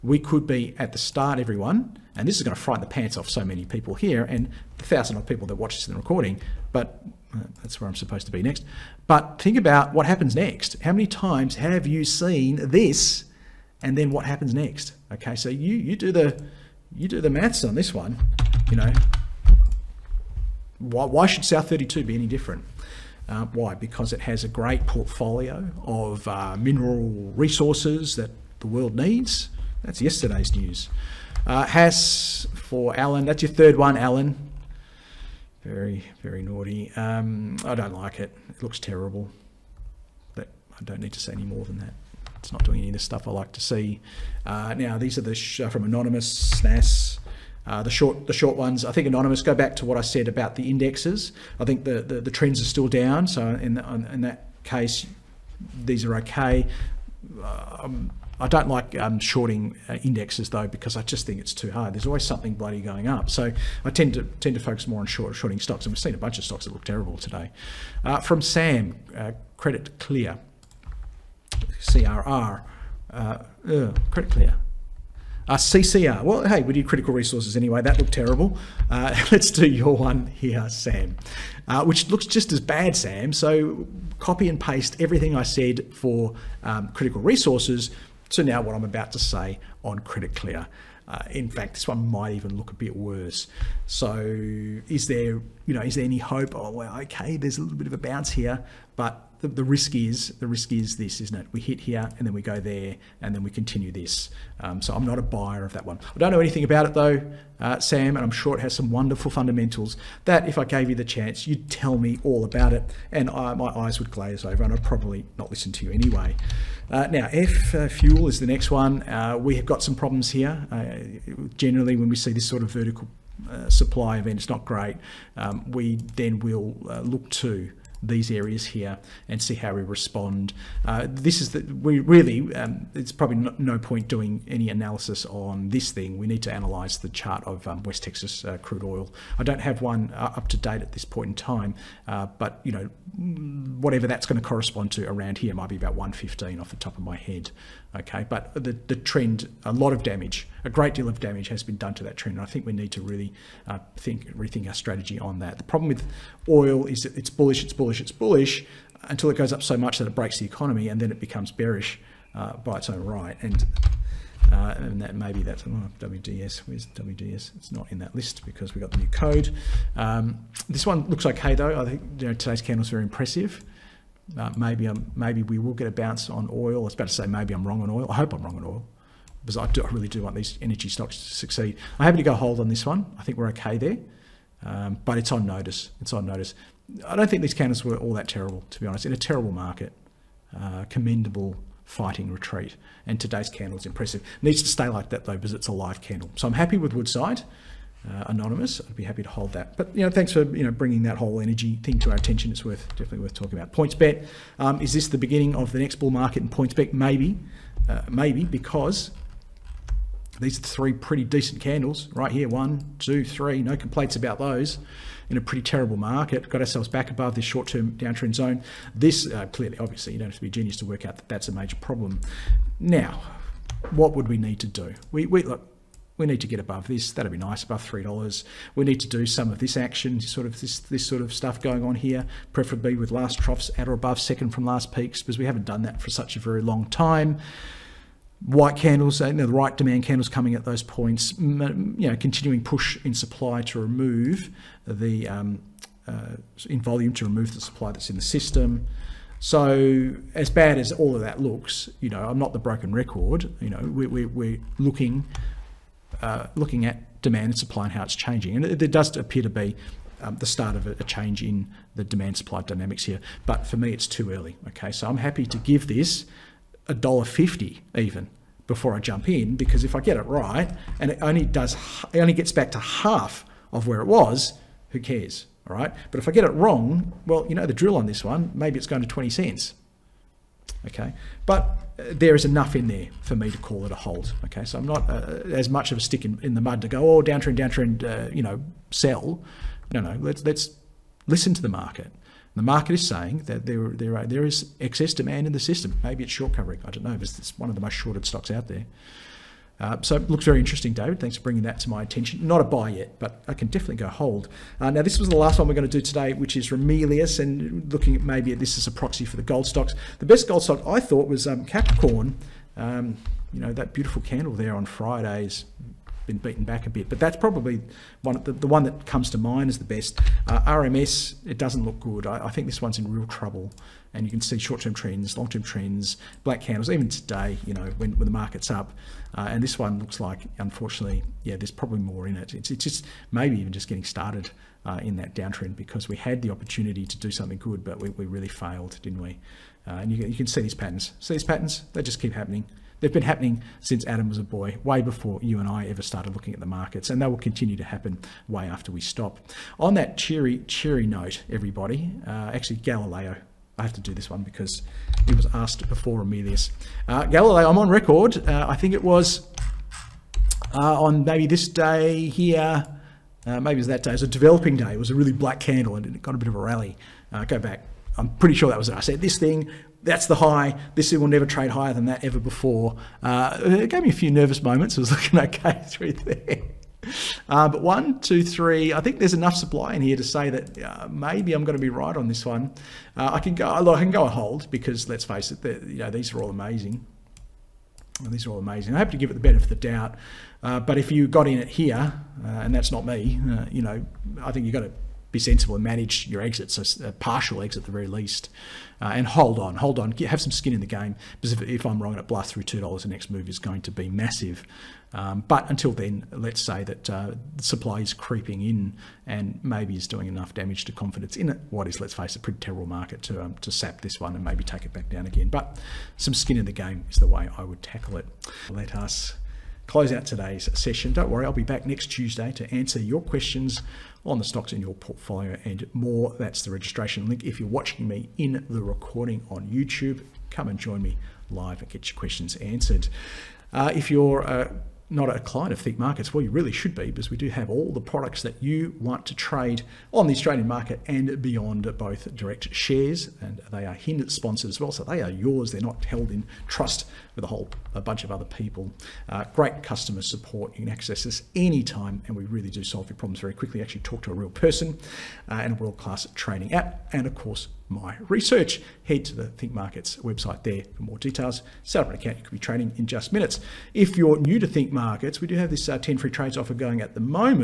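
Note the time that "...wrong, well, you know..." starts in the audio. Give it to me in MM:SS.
04:36.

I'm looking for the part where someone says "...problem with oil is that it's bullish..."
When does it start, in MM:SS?
02:35.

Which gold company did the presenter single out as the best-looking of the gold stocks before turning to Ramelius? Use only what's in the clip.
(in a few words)
Capricorn.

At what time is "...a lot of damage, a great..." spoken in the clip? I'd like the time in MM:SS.
02:29.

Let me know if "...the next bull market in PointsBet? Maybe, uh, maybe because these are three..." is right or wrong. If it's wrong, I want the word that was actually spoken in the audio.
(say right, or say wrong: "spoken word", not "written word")
right.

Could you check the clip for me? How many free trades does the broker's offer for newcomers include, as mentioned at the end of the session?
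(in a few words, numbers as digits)
10.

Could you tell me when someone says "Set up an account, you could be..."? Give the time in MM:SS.
07:41.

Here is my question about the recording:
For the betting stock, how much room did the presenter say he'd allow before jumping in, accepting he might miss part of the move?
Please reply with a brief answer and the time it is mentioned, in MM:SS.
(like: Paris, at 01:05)
$1.50, at 04:26.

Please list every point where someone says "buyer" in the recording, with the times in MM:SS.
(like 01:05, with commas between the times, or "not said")
01:45.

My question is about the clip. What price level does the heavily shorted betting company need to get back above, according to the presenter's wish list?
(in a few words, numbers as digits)
$3.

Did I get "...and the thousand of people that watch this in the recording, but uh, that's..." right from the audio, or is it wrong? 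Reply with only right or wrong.
right.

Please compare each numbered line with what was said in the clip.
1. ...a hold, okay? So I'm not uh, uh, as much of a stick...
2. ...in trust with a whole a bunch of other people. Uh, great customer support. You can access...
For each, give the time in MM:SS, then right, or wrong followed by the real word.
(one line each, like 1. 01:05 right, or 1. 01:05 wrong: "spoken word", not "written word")
1. 04:43 right
2. 07:26 right.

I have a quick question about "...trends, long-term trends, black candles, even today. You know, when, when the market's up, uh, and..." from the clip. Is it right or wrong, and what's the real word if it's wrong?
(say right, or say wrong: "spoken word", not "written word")
right.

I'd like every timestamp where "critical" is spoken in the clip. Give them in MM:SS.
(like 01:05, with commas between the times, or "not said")
01:16, 01:26.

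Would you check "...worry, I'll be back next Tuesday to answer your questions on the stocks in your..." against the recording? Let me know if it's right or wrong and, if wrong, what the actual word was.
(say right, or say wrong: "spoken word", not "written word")
right.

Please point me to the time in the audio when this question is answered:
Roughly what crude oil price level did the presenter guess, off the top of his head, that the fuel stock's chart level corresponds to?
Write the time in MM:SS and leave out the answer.
02:25.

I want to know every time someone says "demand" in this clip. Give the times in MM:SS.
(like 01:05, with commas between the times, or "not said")
03:59, 04:17, 04:22, 04:55.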